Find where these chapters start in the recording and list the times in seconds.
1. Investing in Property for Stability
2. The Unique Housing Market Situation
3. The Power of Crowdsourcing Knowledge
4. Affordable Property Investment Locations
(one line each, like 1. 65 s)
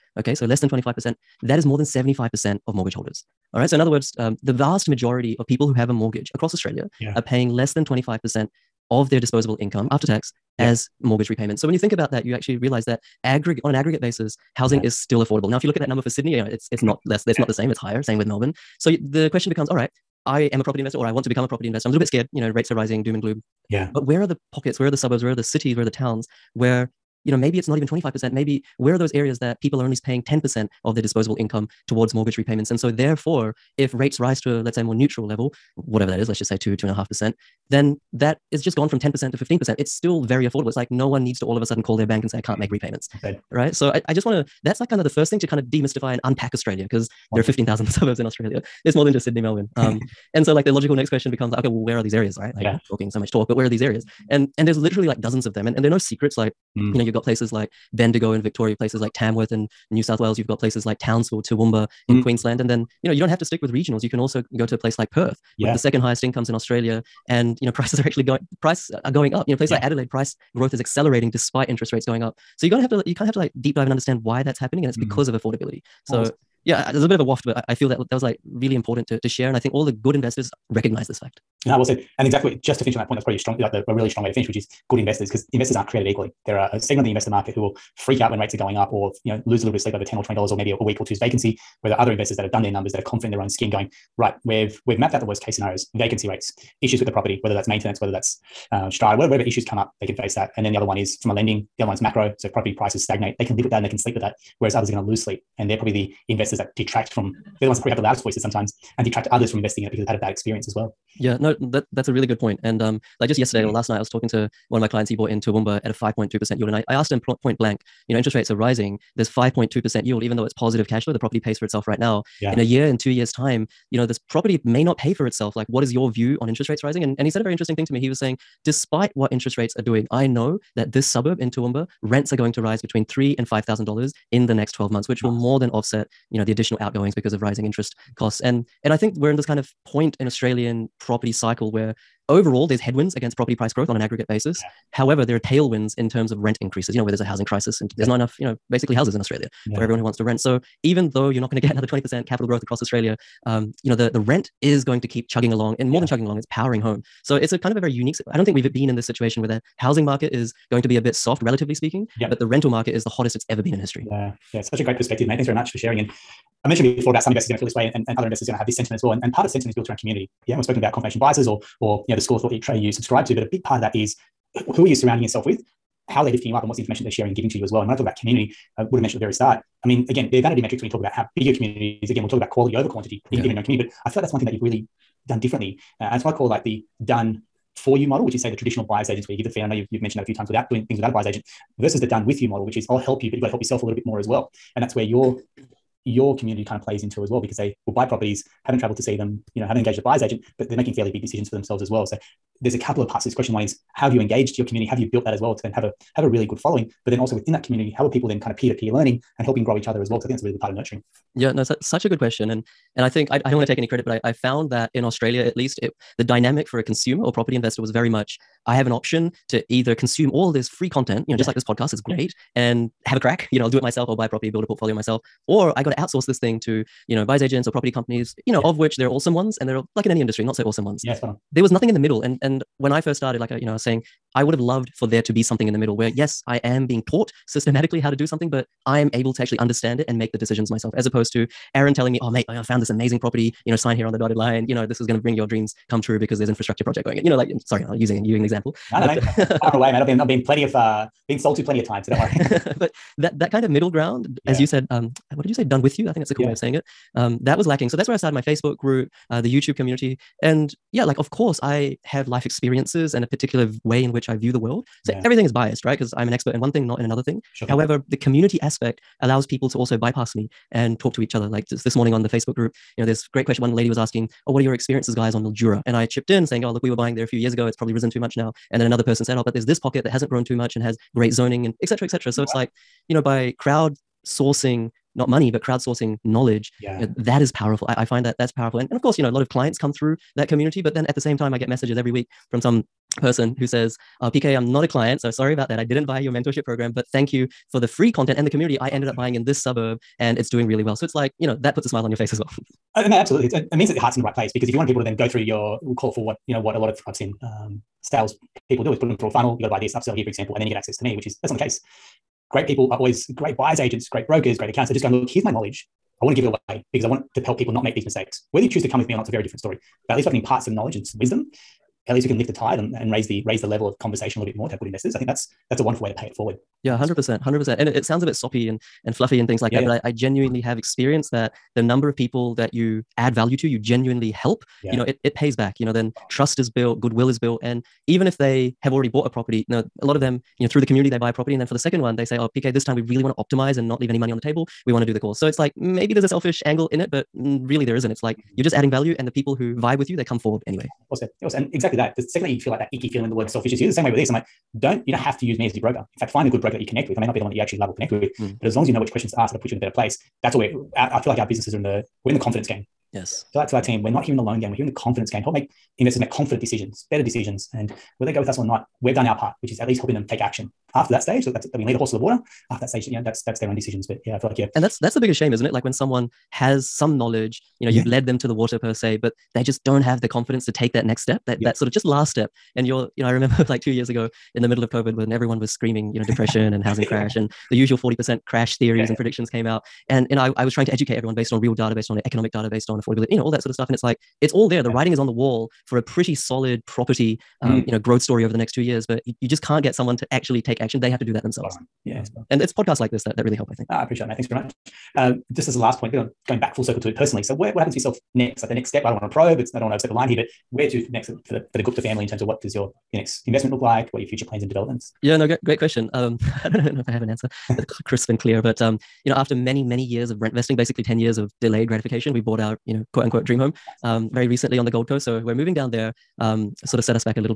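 1. 407 s
2. 151 s
3. 275 s
4. 16 s.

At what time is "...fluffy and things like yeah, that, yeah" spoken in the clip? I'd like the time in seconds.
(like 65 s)
329 s.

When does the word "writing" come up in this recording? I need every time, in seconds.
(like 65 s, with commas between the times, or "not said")
394 s.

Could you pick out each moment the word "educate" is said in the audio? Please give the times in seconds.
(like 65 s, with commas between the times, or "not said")
390 s.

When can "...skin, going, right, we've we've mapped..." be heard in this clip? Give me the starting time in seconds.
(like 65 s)
93 s.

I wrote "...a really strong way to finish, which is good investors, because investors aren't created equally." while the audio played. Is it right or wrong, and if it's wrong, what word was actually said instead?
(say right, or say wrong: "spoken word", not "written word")
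right.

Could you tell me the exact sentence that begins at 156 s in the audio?
than chugging along, it's powering home.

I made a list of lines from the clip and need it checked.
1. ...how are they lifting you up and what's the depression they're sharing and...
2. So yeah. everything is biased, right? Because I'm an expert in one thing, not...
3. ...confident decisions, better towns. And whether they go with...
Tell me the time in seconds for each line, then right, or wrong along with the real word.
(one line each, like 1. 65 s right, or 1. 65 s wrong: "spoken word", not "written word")
1. 176 s wrong: "information", not "depression"
2. 265 s right
3. 366 s wrong: "decisions", not "towns".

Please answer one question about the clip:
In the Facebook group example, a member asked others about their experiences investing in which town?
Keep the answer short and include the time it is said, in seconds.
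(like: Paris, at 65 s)
Mildura, at 275 s.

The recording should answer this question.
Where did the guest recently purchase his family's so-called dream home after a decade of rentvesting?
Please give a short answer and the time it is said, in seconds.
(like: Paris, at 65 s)
Gold Coast, at 424 s.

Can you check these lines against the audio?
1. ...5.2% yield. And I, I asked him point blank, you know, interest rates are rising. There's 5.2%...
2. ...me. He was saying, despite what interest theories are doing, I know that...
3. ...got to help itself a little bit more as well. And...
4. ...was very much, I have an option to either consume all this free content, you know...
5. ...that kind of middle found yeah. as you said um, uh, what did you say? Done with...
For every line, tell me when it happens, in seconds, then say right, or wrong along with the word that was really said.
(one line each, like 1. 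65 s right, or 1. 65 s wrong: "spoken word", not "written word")
1. 115 s right
2. 127 s wrong: "rates", not "theories"
3. 193 s wrong: "yourself", not "itself"
4. 217 s right
5. 253 s wrong: "ground", not "found".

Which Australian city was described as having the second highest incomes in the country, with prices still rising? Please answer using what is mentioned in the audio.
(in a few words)
Perth.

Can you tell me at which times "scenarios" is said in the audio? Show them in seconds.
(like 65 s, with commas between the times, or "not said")
95 s.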